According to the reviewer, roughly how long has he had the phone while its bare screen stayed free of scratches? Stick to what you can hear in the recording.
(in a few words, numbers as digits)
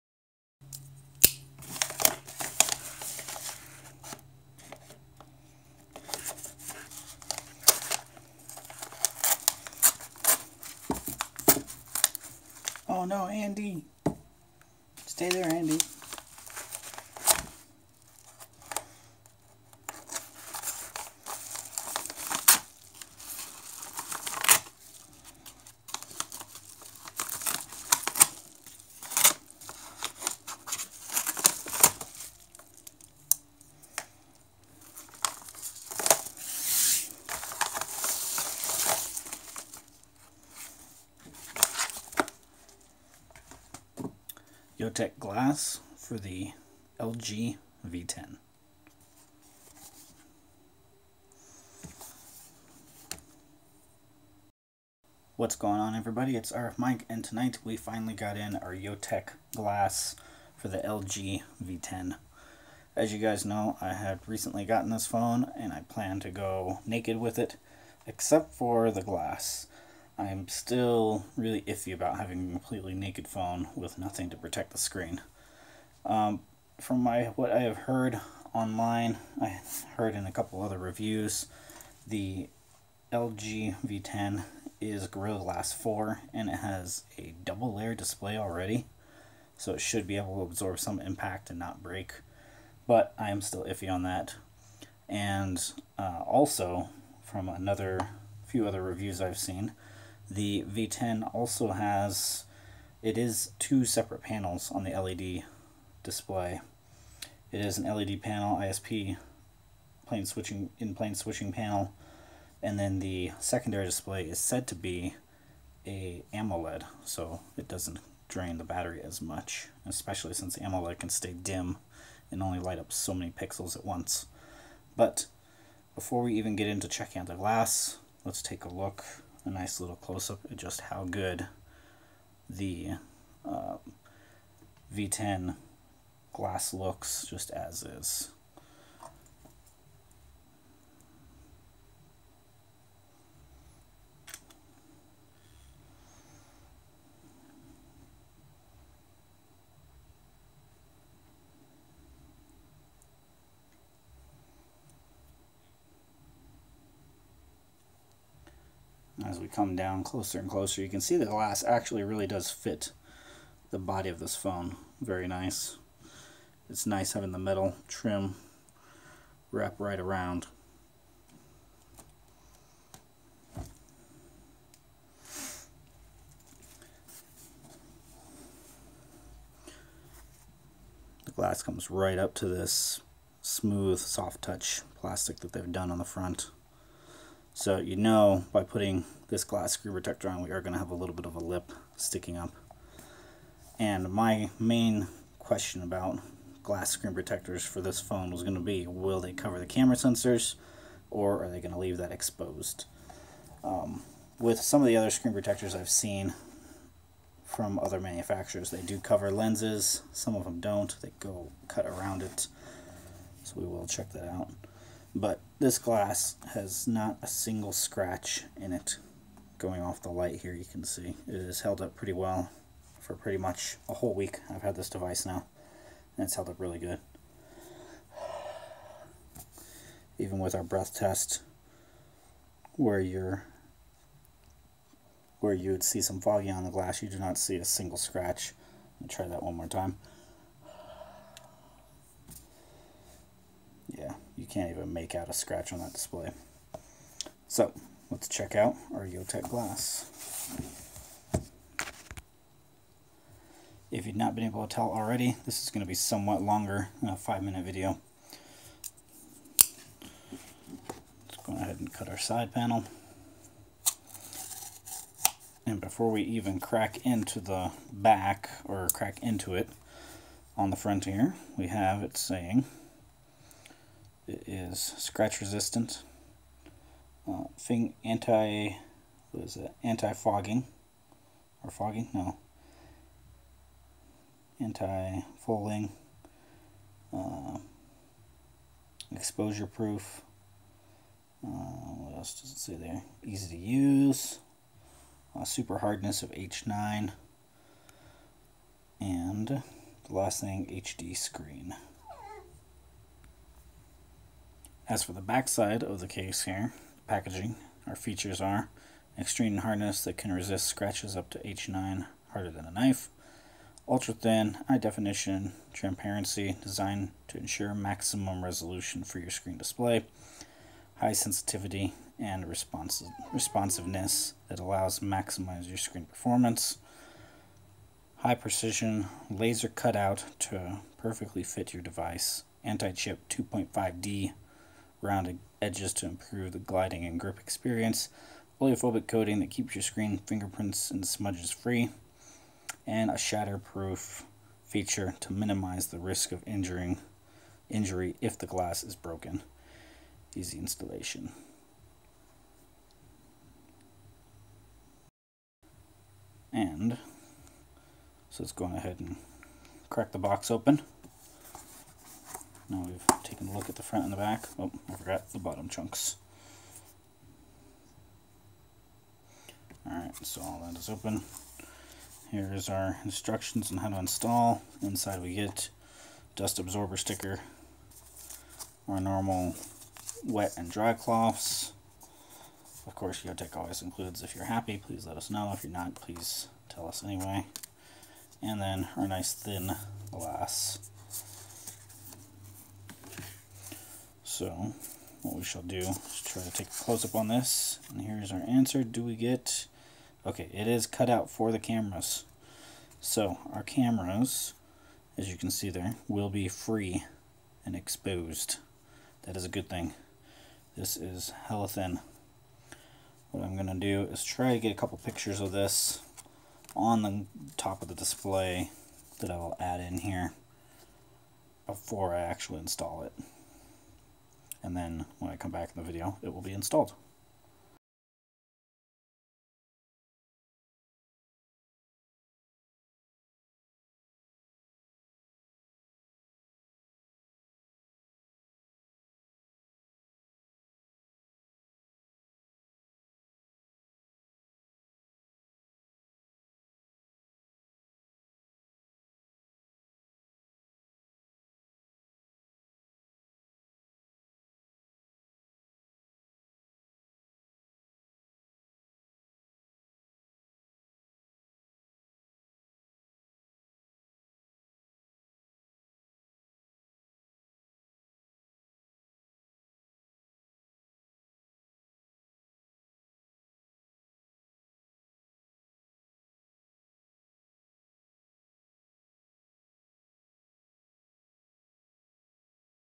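a whole week.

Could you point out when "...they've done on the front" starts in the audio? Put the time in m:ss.
3:05.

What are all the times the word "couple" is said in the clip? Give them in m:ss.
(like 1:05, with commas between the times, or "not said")
1:20, 6:54.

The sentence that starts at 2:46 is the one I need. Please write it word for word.
It's nice having the metal trim wrap right around.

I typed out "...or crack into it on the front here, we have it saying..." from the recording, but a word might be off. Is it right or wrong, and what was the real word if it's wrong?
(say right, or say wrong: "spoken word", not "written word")
right.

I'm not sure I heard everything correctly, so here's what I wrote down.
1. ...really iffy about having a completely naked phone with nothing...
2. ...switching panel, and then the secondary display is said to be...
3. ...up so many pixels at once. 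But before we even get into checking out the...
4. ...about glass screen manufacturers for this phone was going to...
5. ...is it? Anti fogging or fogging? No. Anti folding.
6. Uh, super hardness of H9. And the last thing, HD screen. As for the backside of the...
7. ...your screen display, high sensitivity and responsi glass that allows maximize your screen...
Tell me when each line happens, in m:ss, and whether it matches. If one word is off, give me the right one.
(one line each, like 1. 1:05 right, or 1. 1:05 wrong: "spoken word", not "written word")
1. 1:11 right
2. 1:51 right
3. 2:02 right
4. 3:15 wrong: "protectors", not "manufacturers"
5. 4:39 right
6. 4:55 right
7. 5:19 wrong: "responsiveness", not "glass".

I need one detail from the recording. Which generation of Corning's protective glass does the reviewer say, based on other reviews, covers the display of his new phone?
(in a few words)
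Gorilla Glass 4.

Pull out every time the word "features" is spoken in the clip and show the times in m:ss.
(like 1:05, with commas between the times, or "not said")
5:07, 5:44.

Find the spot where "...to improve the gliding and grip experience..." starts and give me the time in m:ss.
5:35.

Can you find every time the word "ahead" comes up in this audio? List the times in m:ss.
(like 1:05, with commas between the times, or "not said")
4:21, 5:58.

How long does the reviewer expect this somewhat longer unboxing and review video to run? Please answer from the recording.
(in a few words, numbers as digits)
5 minutes.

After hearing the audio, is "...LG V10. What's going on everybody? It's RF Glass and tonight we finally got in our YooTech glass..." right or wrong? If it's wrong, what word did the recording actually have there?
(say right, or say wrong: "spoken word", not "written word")
wrong: "Mike", not "Glass".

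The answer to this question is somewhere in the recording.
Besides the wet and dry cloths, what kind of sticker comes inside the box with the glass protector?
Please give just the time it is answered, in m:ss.
6:16.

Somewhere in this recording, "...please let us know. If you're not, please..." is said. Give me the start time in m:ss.
6:24.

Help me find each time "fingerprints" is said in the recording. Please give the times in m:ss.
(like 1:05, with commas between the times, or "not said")
5:40.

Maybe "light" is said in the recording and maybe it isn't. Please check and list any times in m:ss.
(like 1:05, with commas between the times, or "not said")
2:02, 3:40.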